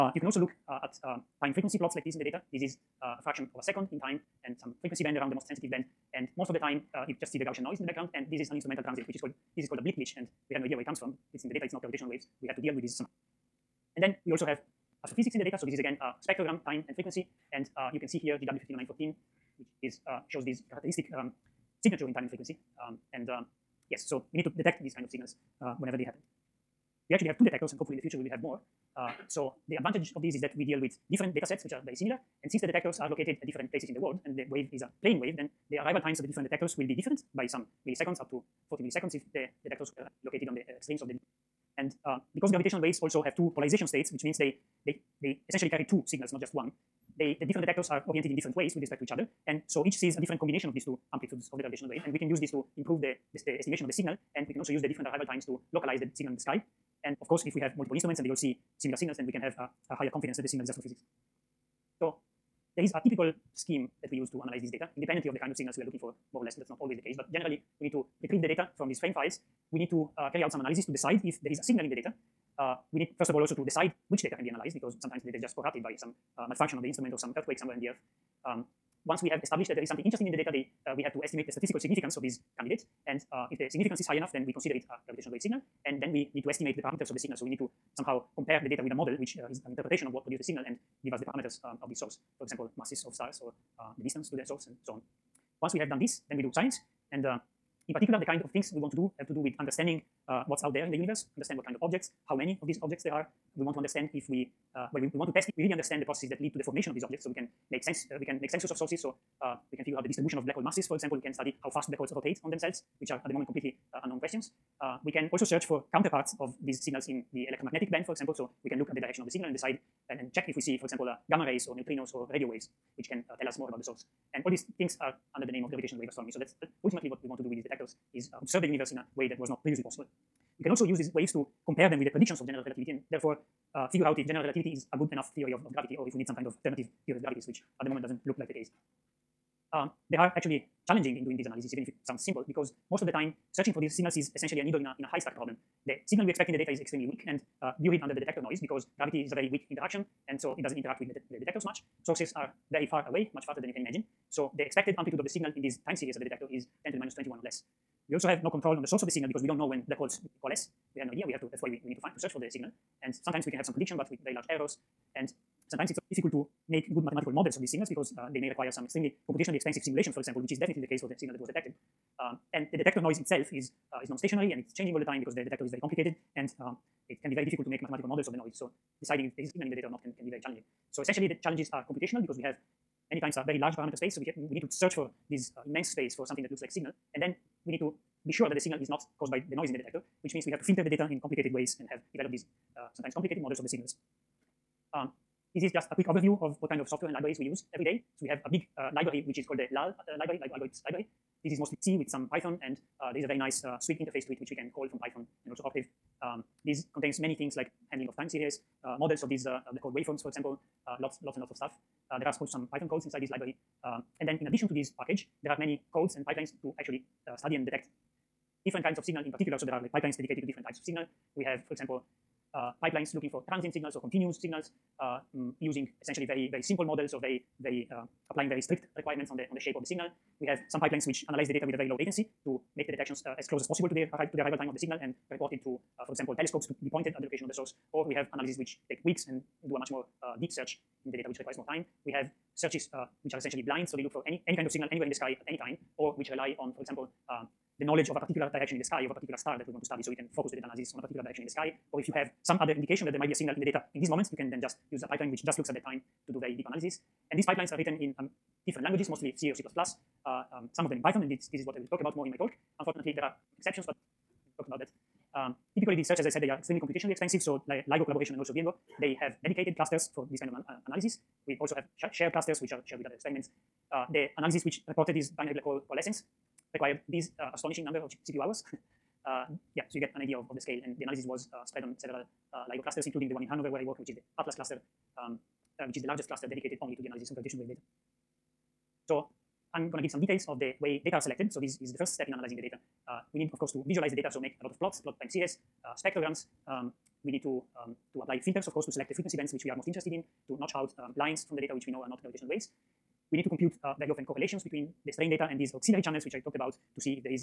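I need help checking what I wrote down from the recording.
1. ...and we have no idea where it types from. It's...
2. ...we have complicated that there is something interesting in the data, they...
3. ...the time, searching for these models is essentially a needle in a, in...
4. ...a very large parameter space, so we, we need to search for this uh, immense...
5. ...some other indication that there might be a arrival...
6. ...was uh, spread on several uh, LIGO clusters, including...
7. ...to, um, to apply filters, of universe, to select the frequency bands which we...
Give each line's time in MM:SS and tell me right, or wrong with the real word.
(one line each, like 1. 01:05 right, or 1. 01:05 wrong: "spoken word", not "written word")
1. 00:10 wrong: "comes", not "types"
2. 01:19 wrong: "established", not "complicated"
3. 02:23 wrong: "signals", not "models"
4. 03:03 right
5. 04:12 wrong: "signal", not "arrival"
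6. 04:41 right
7. 04:57 wrong: "course", not "universe".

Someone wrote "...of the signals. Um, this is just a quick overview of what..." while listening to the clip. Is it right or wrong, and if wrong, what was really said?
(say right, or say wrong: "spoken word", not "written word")
right.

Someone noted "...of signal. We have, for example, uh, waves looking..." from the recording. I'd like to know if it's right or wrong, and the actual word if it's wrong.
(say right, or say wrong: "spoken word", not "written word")
wrong: "pipelines", not "waves".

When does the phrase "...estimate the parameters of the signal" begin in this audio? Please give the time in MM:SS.
01:26.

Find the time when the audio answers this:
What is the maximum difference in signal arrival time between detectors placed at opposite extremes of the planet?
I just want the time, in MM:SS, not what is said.
00:38.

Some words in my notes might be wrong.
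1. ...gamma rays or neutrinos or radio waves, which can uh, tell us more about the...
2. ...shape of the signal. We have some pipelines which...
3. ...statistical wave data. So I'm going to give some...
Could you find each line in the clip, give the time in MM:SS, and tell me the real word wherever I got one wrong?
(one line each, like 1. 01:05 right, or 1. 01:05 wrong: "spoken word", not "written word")
1. 02:01 right
2. 03:49 right
3. 04:47 wrong: "gravitational", not "statistical".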